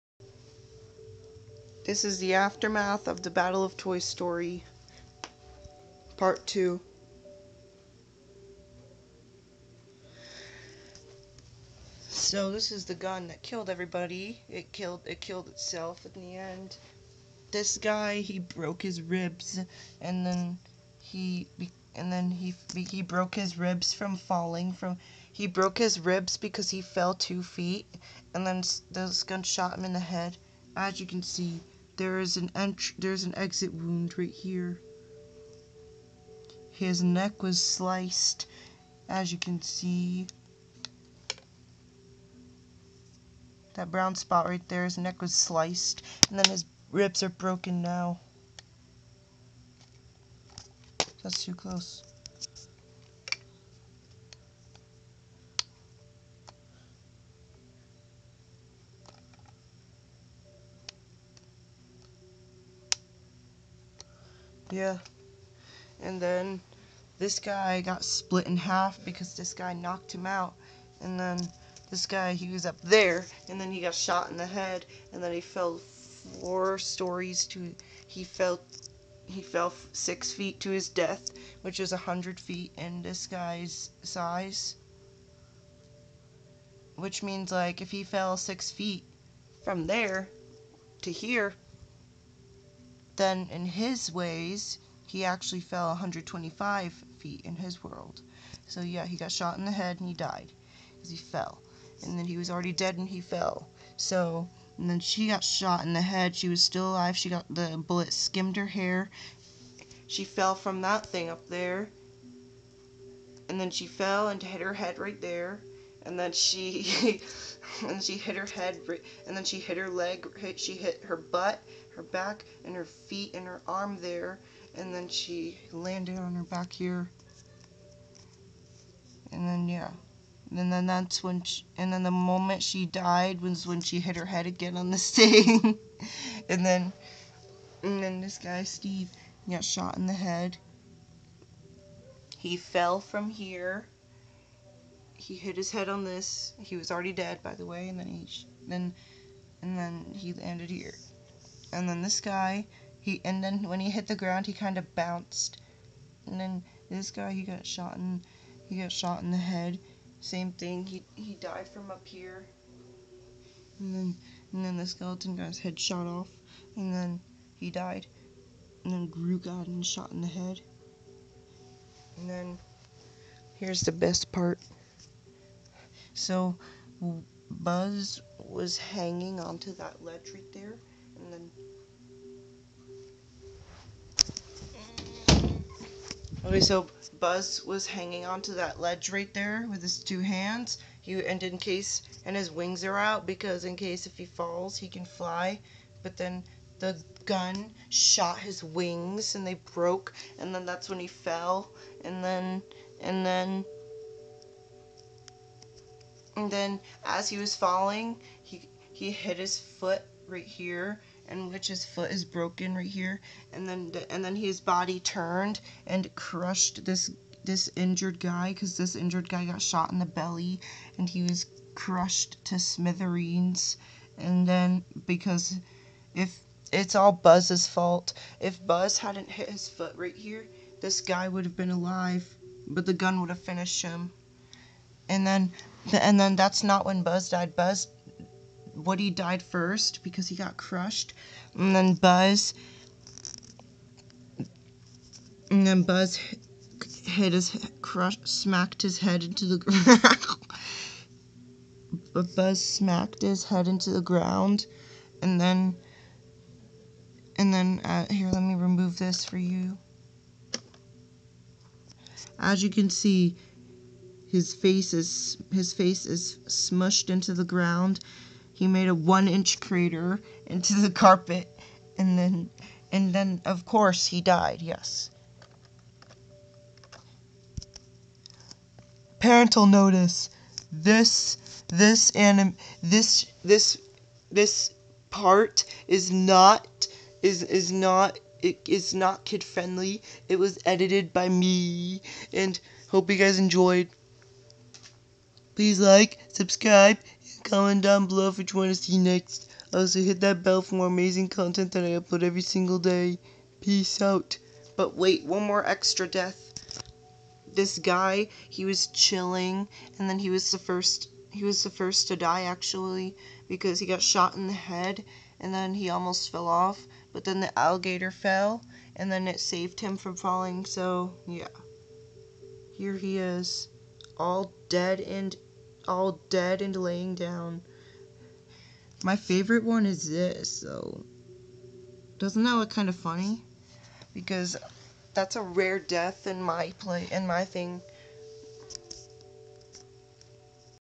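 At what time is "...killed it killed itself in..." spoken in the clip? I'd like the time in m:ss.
0:14.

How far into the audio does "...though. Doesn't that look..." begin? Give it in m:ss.
5:30.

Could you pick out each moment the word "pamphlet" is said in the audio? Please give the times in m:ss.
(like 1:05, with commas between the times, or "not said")
not said.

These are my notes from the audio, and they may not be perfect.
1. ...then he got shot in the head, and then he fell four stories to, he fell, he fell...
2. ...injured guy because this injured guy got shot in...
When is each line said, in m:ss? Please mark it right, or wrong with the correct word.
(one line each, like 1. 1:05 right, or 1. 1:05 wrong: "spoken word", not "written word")
1. 1:13 right
2. 3:37 right.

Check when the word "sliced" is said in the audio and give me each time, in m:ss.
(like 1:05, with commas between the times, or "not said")
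0:37, 0:45.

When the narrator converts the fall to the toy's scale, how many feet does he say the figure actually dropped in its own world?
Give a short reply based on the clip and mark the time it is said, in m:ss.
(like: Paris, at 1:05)
125 feet, at 1:35.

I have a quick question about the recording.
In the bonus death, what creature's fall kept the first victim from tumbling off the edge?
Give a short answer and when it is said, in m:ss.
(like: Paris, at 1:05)
the alligator, at 5:17.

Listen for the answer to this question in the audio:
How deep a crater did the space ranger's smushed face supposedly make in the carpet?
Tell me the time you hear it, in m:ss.
4:28.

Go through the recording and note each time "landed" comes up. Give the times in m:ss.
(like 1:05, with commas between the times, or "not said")
2:05, 2:30.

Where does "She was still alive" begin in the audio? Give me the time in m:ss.
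1:46.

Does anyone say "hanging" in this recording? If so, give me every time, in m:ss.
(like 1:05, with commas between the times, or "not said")
2:58, 3:07.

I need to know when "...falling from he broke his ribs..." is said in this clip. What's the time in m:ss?
0:24.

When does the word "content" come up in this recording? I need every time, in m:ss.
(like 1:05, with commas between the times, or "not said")
5:01.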